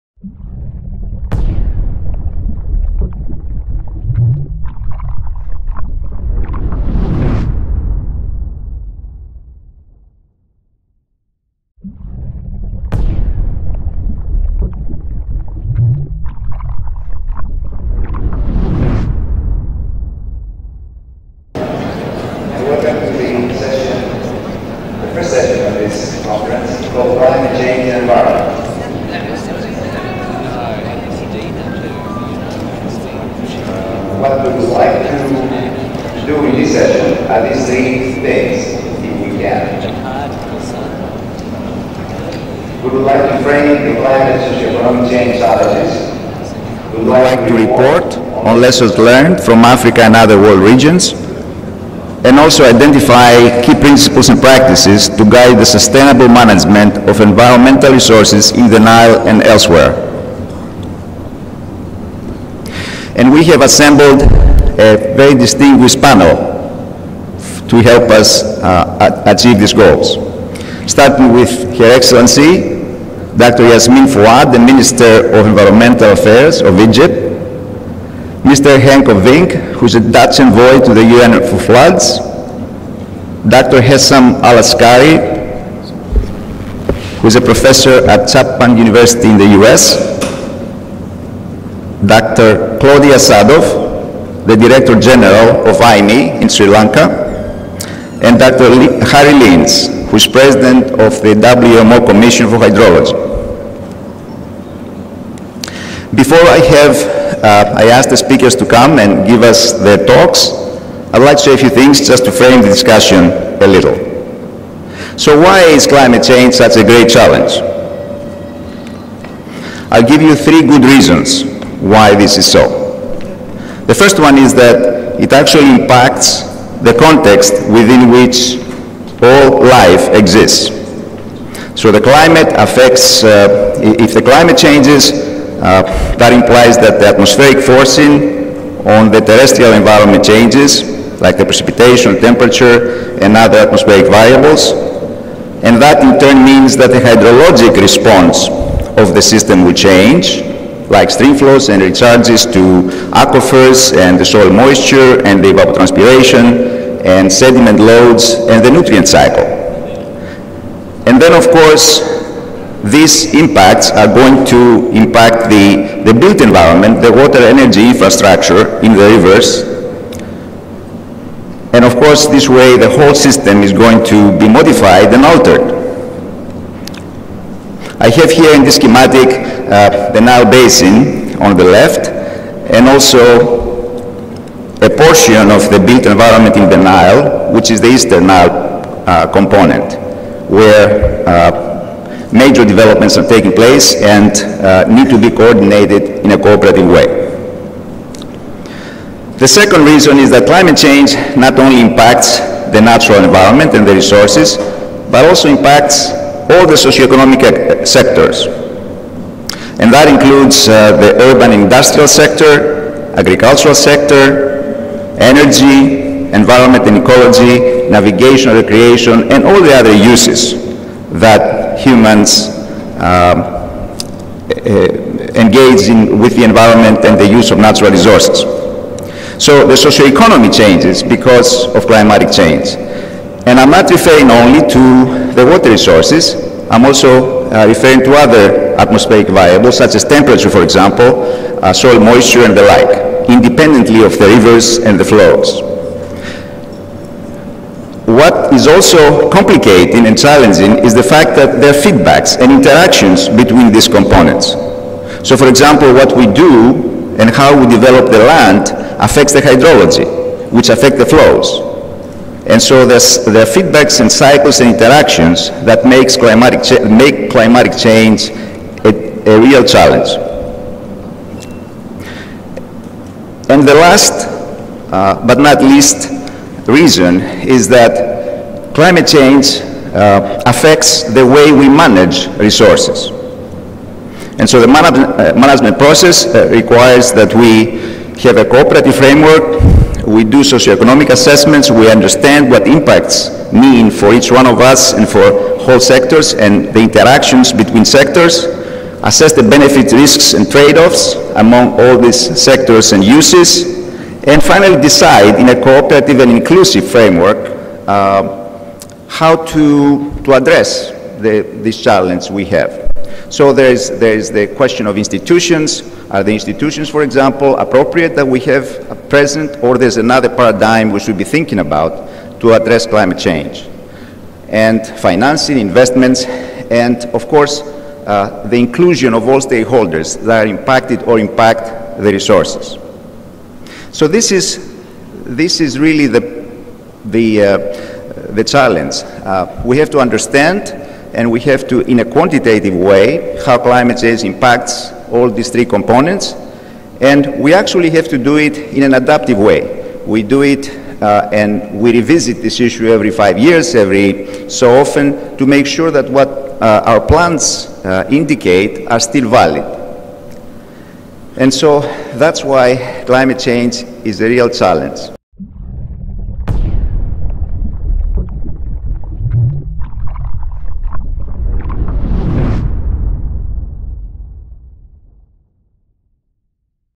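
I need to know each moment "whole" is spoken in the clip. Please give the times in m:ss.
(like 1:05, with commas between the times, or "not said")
2:52, 4:55.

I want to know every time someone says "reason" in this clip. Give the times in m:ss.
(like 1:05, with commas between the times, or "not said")
2:00, 3:19, 4:36.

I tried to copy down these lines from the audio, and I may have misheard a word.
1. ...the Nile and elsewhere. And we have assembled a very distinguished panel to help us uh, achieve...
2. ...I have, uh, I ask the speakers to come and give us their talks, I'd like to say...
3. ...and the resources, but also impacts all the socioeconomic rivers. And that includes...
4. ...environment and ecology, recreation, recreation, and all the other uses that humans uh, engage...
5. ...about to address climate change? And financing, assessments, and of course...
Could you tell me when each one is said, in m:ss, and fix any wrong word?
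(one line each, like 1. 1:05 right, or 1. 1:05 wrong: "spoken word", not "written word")
1. 0:58 right
2. 1:46 right
3. 3:23 wrong: "sectors", not "rivers"
4. 3:36 wrong: "navigation", not "recreation"
5. 5:21 wrong: "investments", not "assessments".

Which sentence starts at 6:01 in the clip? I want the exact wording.
And so that's why climate change is a real challenge.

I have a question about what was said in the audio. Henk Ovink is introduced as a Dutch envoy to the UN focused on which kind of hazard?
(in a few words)
Floods.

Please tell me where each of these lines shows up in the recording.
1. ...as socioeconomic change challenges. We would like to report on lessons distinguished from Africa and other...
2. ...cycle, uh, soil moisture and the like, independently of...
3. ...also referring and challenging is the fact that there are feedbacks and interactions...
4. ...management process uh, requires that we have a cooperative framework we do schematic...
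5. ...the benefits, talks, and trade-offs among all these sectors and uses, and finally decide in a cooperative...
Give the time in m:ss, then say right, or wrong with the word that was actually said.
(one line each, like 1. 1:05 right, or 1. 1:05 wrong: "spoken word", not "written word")
1. 0:44 wrong: "learned", not "distinguished"
2. 4:00 wrong: "example", not "cycle"
3. 4:08 wrong: "complicating", not "referring"
4. 4:45 wrong: "socioeconomic", not "schematic"
5. 4:59 wrong: "risks", not "talks".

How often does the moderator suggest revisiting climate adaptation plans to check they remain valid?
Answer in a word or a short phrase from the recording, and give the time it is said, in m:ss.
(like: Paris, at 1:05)
Every 5 years, at 5:52.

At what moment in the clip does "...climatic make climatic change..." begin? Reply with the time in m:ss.
4:26.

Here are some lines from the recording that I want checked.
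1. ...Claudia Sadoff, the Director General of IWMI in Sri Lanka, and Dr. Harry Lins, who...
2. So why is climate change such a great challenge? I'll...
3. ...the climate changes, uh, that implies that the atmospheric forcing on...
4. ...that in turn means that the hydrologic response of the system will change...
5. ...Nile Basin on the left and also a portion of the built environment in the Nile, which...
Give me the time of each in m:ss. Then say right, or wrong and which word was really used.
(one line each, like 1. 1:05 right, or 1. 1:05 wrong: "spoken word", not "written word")
1. 1:32 right
2. 1:55 right
3. 2:14 right
4. 2:25 right
5. 3:00 right.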